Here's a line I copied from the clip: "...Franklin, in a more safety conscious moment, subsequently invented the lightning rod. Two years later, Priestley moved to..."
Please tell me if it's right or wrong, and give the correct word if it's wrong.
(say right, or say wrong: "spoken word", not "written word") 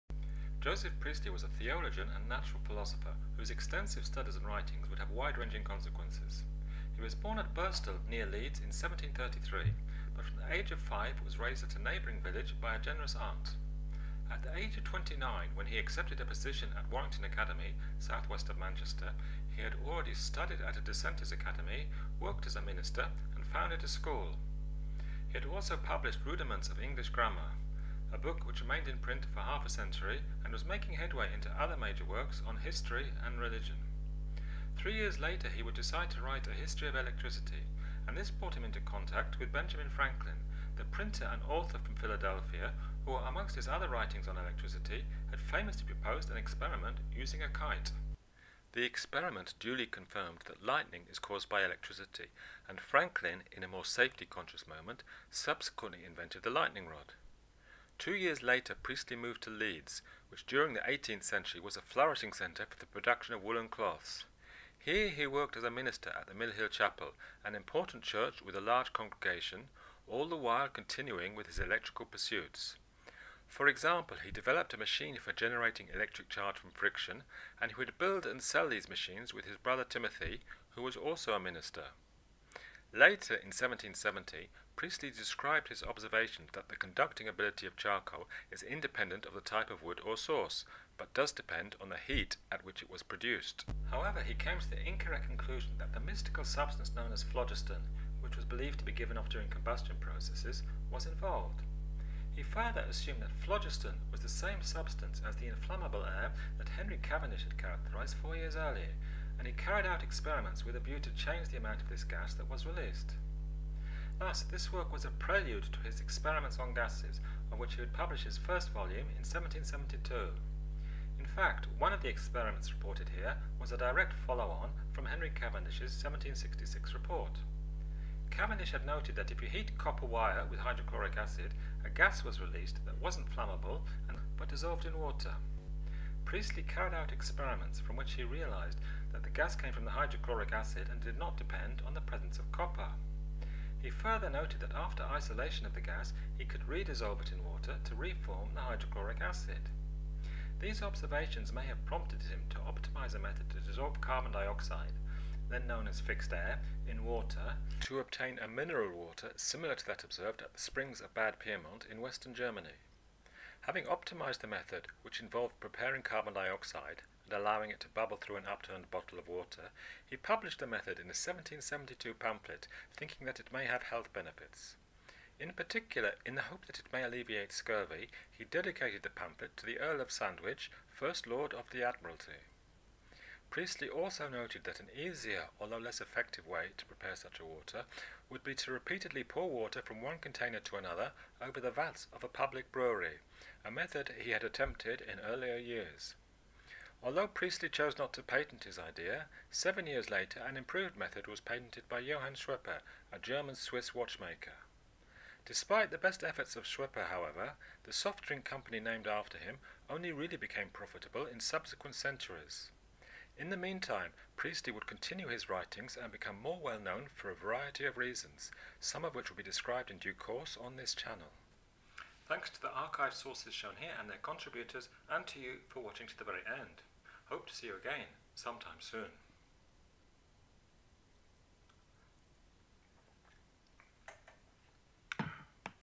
right.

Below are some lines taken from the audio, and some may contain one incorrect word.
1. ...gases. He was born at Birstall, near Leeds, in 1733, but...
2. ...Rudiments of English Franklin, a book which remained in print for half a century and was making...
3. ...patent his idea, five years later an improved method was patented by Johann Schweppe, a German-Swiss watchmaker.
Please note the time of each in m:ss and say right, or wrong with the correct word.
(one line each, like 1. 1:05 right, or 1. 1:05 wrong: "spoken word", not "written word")
1. 0:05 wrong: "consequences", not "gases"
2. 0:26 wrong: "Grammar", not "Franklin"
3. 3:18 wrong: "seven", not "five".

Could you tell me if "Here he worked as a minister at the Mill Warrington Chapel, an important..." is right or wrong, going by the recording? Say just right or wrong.
wrong.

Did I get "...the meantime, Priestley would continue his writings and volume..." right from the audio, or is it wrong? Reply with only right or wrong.
wrong.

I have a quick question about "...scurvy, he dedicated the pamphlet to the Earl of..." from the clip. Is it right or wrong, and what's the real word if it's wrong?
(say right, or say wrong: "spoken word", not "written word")
right.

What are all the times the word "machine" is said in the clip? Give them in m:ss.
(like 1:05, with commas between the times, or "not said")
1:14, 1:18.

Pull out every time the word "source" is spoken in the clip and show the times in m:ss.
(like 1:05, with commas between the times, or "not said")
1:30, 3:43.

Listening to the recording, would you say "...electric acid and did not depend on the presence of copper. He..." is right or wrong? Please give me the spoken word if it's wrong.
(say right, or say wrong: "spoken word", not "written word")
wrong: "hydrochloric", not "electric".